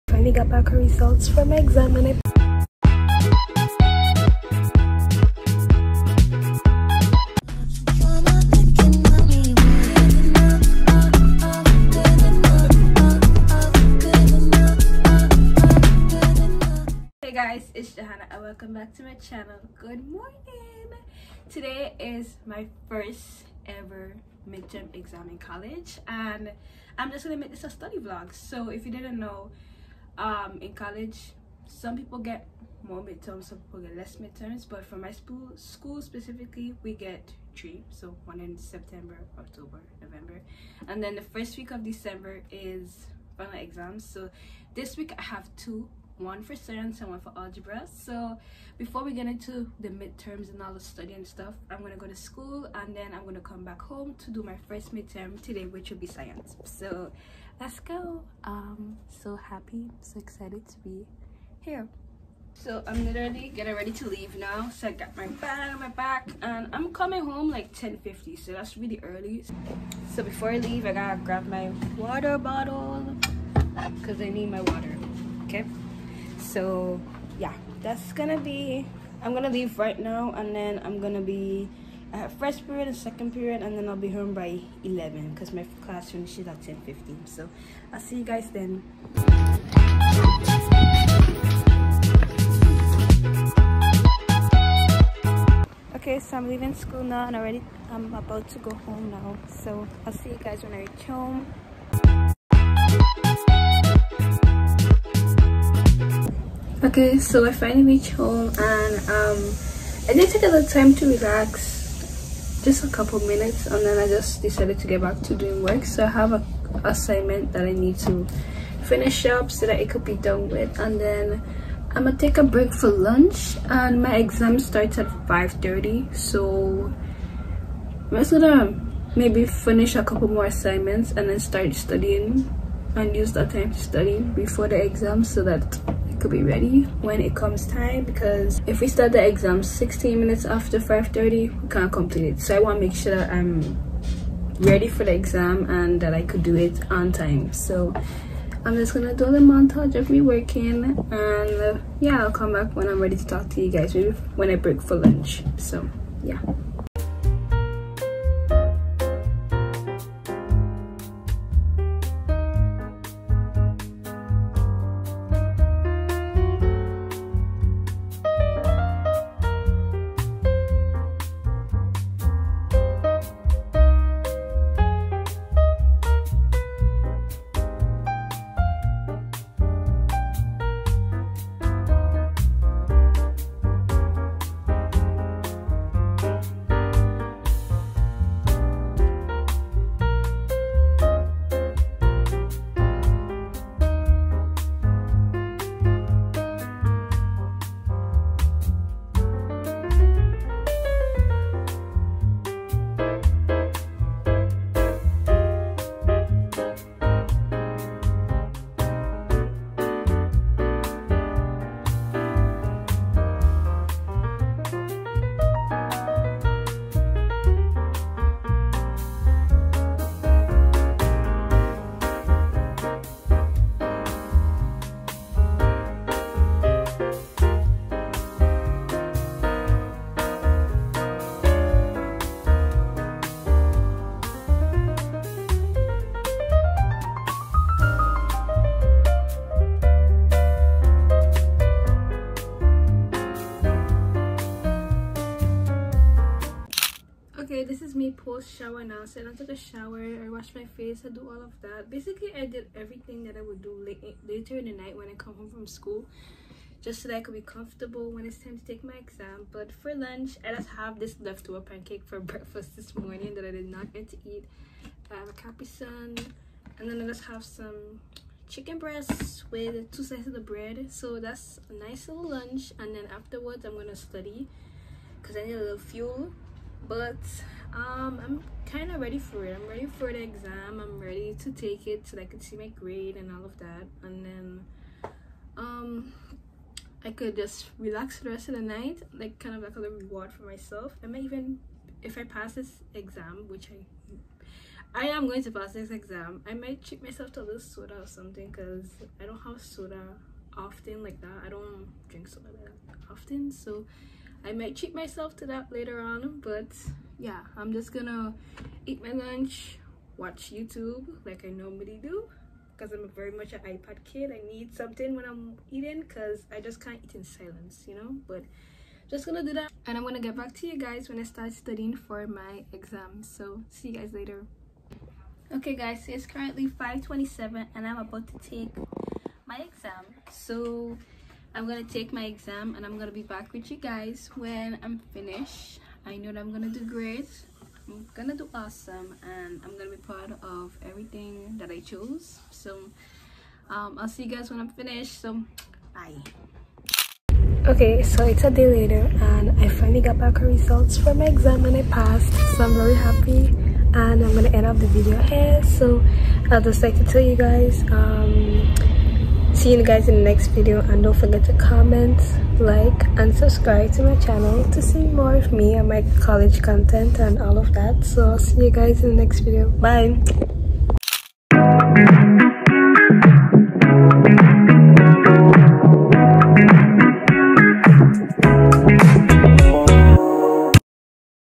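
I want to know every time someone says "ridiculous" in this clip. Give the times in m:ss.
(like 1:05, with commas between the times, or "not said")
not said.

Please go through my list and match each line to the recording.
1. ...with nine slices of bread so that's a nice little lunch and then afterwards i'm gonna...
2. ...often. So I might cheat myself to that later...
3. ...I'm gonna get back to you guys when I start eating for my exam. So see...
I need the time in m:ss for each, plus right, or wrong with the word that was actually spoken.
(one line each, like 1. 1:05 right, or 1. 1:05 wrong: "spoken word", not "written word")
1. 4:29 wrong: "two", not "nine"
2. 5:03 right
3. 5:19 wrong: "studying", not "eating".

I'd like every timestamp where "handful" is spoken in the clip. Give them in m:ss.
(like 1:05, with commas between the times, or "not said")
not said.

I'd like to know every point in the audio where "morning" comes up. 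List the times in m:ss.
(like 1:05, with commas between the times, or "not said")
0:20, 4:22.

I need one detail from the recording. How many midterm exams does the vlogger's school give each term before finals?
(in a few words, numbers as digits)
3.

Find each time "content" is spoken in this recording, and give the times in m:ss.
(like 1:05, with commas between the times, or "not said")
6:06.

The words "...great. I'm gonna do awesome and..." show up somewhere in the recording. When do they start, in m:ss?
5:36.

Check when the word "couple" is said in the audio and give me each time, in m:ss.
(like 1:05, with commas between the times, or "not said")
1:52, 2:10.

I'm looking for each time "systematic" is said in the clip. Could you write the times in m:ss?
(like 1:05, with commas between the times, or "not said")
not said.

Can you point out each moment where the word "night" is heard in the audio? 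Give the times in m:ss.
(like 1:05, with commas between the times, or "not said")
4:14, 4:48.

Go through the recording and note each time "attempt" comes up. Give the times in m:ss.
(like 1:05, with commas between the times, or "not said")
not said.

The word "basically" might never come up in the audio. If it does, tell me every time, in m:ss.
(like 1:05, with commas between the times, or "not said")
4:11.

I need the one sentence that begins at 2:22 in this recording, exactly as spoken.
So I want to make sure that I'm ready for the exam and that I could do it on time.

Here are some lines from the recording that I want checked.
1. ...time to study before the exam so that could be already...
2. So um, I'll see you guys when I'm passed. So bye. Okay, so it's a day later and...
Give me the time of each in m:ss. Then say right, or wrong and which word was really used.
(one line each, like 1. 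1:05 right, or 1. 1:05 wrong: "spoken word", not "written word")
1. 2:13 wrong: "ready", not "already"
2. 5:42 wrong: "finished", not "passed".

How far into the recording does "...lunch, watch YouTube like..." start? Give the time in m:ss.
5:09.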